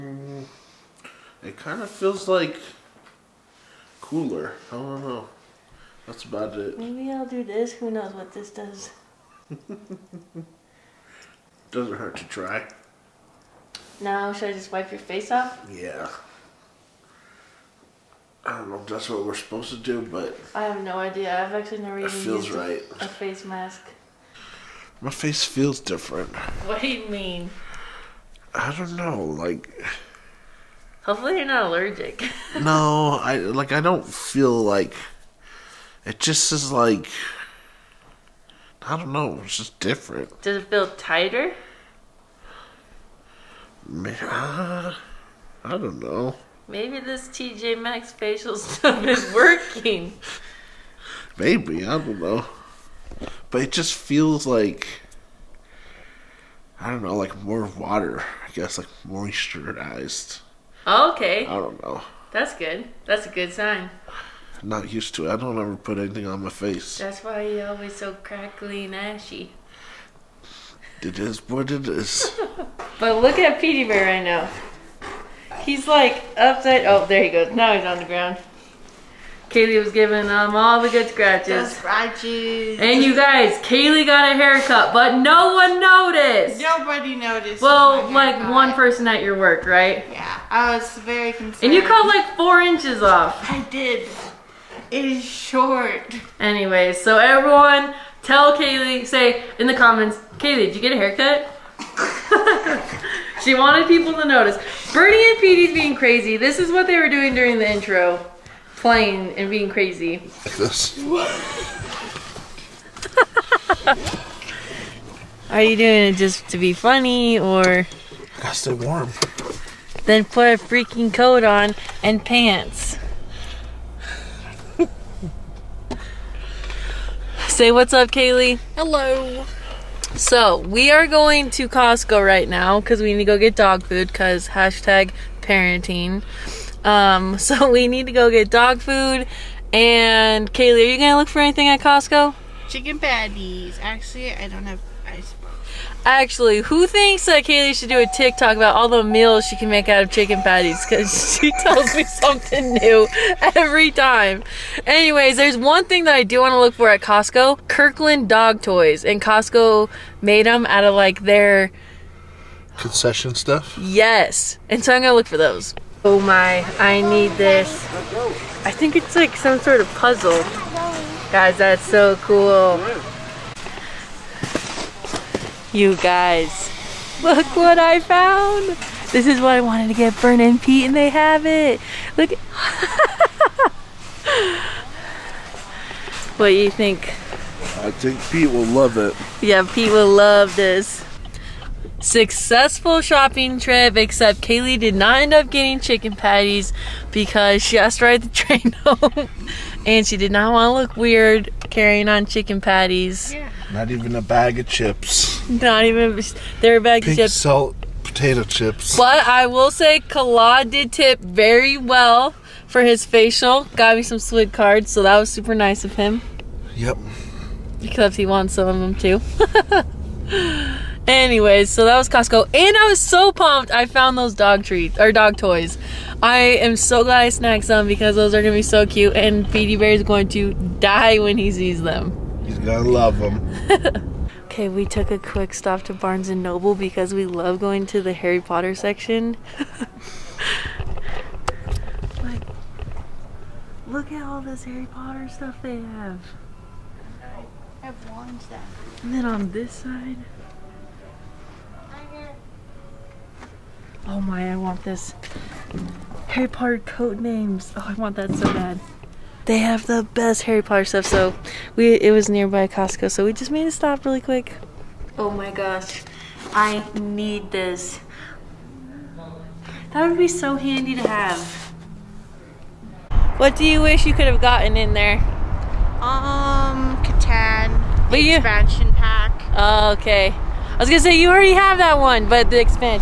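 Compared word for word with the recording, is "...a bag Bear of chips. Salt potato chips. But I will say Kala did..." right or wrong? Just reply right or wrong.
wrong.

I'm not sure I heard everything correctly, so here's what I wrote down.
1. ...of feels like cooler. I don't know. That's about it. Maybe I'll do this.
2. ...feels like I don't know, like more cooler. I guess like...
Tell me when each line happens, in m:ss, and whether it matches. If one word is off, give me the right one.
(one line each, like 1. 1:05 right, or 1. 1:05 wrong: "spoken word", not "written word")
1. 0:01 right
2. 0:53 wrong: "water", not "cooler".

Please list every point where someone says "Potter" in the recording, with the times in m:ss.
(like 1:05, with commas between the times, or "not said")
3:58, 4:04, 4:16, 4:20.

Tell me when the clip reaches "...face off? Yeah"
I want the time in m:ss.
0:14.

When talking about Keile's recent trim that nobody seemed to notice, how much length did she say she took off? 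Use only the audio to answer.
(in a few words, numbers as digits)
4 inches.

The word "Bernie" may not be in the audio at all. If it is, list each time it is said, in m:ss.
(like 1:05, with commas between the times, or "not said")
1:44.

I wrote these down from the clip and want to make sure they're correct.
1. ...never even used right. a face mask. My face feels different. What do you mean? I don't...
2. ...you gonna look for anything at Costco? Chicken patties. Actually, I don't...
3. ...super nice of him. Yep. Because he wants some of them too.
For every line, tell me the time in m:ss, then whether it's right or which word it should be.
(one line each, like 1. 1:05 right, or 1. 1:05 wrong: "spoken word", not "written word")
1. 0:21 right
2. 2:20 right
3. 3:35 right.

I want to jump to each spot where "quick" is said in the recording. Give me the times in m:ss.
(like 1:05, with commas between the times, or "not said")
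3:55, 4:24.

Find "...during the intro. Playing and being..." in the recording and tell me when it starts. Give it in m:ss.
1:47.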